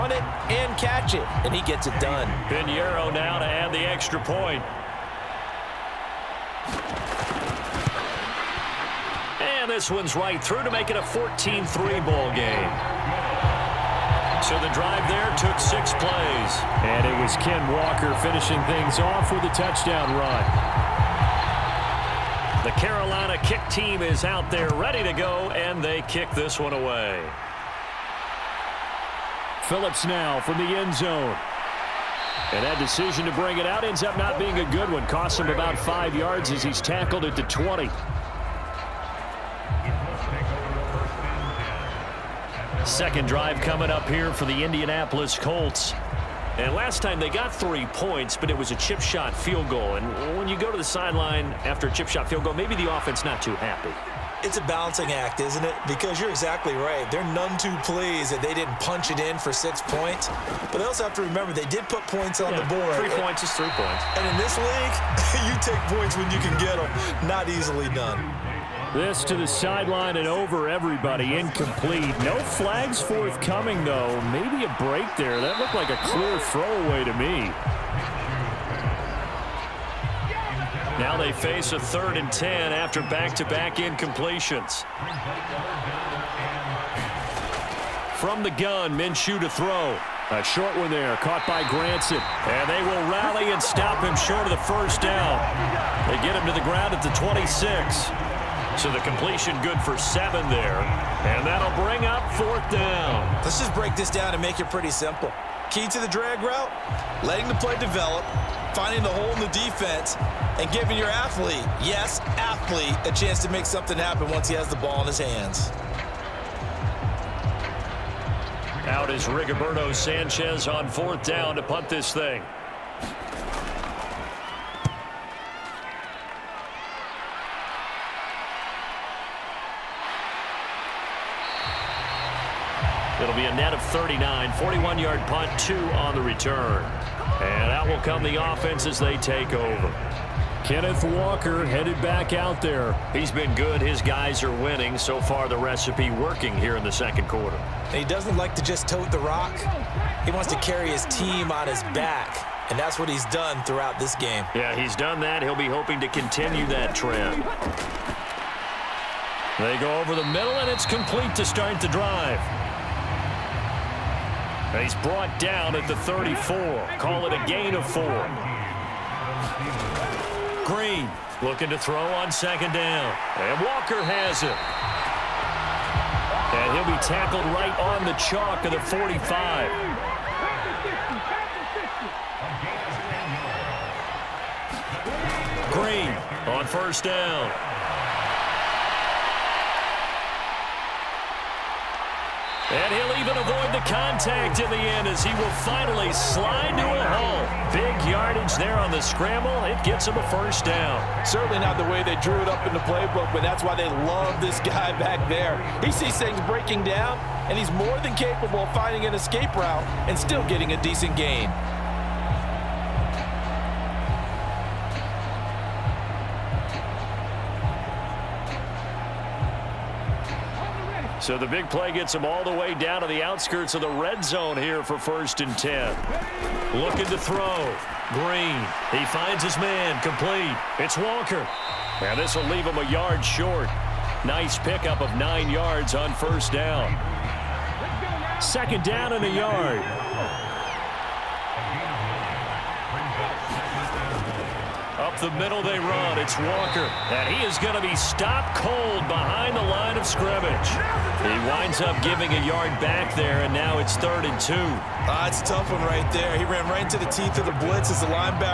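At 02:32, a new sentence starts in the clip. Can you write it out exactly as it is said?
And that's what he's done throughout this game.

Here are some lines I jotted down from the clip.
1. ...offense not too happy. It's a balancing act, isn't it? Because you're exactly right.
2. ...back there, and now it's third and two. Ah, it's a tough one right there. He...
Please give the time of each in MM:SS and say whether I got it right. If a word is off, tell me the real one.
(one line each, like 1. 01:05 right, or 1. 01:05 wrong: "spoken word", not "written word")
1. 00:52 right
2. 04:12 right.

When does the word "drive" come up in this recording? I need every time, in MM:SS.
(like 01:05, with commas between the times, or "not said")
00:14, 00:43, 02:41.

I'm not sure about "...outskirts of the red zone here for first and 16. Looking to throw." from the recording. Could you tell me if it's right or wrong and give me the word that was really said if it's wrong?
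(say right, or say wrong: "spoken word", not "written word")
wrong: "10", not "16".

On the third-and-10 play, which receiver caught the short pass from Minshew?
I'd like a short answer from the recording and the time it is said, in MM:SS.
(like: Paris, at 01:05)
Granson, at 01:31.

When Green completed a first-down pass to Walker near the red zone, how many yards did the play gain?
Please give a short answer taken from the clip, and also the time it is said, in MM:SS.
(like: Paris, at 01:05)
9, at 03:55.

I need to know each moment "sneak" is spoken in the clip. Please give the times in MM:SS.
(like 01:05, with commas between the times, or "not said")
not said.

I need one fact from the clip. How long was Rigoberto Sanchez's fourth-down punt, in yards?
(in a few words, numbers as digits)
41.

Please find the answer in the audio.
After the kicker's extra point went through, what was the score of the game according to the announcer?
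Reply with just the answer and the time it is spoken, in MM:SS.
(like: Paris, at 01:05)
14-3, at 00:11.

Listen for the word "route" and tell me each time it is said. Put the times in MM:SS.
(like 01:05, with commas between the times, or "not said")
01:46, 03:29.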